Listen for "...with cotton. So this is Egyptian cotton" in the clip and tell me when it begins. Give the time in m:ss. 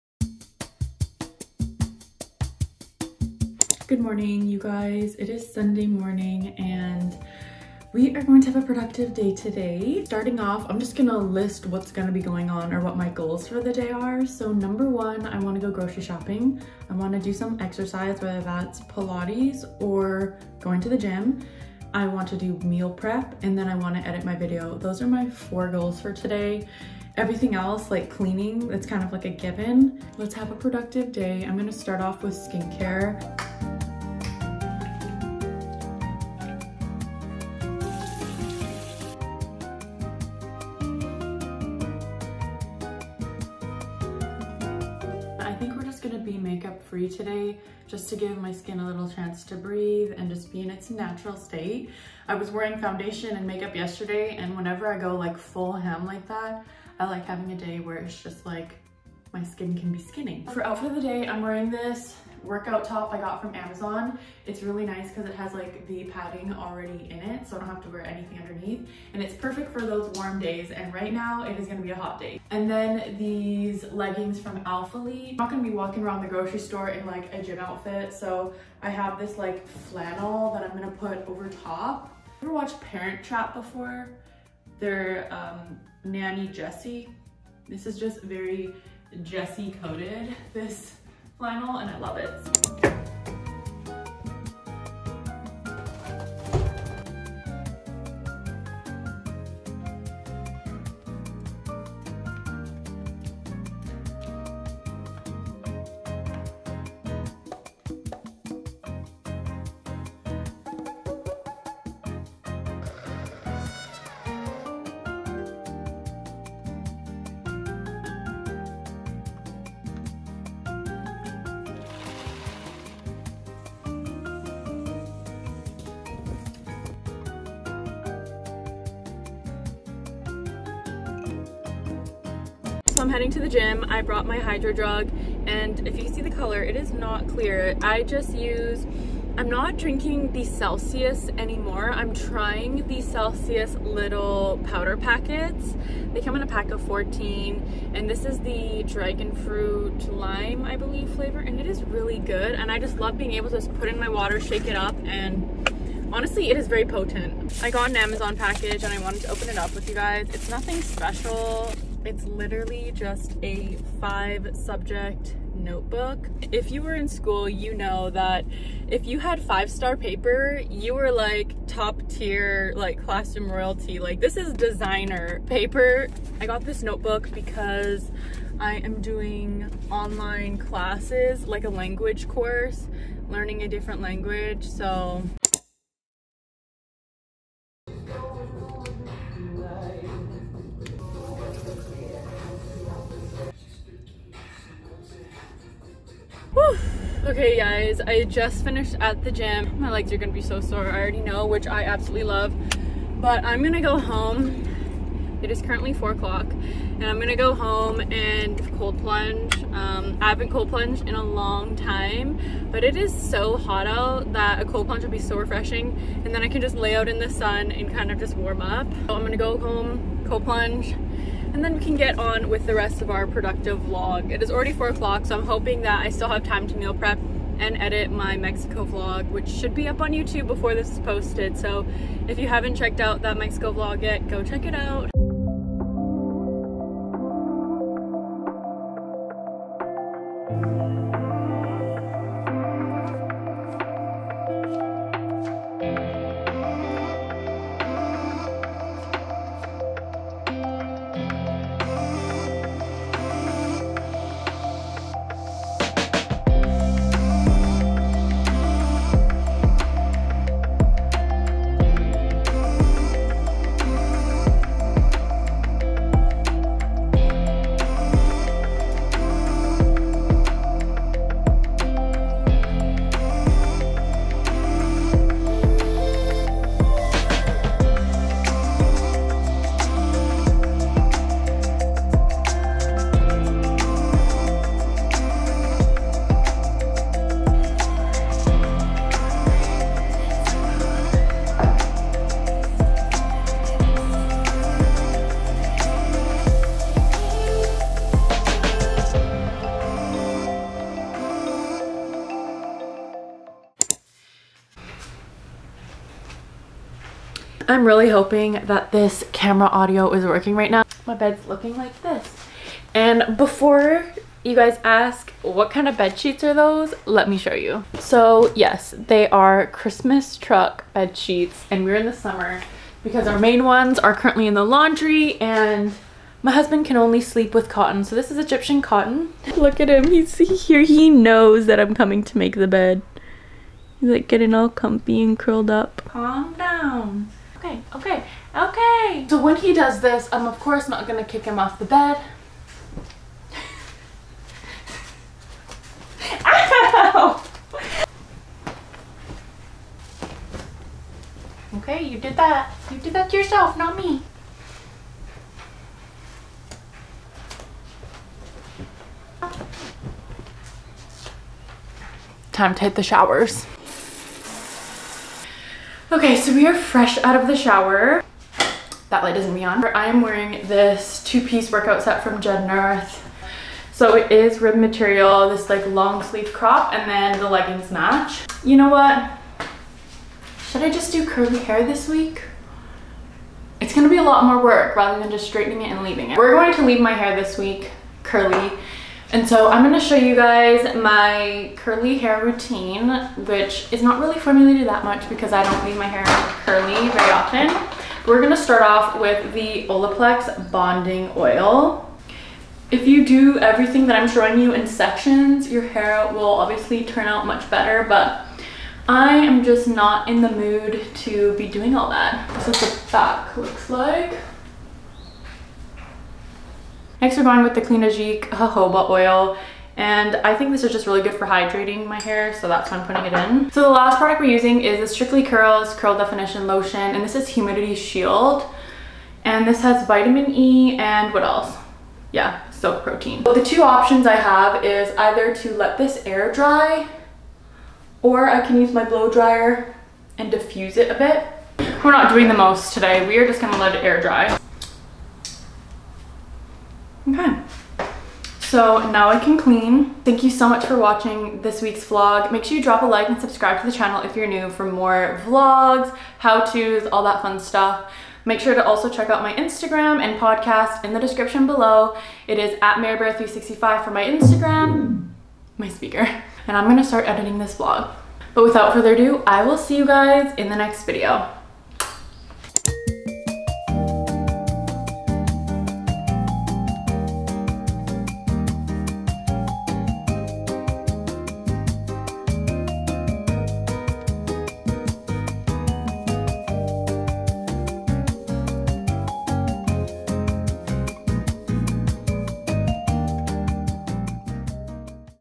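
5:27.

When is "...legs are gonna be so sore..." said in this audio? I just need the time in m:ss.
3:19.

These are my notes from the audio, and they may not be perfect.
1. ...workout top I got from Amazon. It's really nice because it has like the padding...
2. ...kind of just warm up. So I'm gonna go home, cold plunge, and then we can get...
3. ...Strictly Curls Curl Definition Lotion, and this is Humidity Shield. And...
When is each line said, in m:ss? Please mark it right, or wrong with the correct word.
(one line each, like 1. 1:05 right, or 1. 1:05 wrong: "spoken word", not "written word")
1. 1:02 right
2. 3:37 right
3. 7:05 right.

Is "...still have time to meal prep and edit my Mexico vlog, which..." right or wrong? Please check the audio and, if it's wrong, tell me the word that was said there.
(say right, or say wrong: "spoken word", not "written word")
right.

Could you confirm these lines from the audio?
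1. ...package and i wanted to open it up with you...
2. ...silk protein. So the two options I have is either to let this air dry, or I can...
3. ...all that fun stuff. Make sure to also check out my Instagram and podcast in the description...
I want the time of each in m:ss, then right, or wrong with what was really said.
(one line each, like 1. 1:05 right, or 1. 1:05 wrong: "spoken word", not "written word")
1. 2:38 right
2. 7:12 right
3. 7:37 right.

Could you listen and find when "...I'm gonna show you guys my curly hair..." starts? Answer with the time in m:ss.
6:29.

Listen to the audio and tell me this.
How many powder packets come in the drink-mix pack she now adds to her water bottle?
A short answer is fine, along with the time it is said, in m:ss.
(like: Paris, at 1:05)
14, at 2:26.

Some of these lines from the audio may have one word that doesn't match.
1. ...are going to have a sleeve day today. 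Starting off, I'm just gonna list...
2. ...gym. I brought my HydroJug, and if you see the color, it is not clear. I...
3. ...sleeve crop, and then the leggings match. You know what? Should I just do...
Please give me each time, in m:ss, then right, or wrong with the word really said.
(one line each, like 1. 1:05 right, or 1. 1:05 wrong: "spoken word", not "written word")
1. 0:08 wrong: "productive", not "sleeve"
2. 2:13 right
3. 6:16 right.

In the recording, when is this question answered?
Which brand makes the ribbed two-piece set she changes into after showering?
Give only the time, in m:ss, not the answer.
6:12.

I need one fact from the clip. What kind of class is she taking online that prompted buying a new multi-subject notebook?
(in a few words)
a language course.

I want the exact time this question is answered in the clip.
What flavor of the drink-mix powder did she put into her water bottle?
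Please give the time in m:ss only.
2:28.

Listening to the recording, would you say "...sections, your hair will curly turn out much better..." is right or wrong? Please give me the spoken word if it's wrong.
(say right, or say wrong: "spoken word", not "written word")
wrong: "obviously", not "curly".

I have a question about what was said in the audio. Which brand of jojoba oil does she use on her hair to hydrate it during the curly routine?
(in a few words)
Cliganic.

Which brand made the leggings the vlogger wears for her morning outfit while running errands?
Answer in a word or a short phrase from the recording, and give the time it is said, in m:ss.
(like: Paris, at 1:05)
Alphalete, at 1:14.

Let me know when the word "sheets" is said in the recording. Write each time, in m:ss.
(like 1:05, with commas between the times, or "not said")
5:16, 5:21.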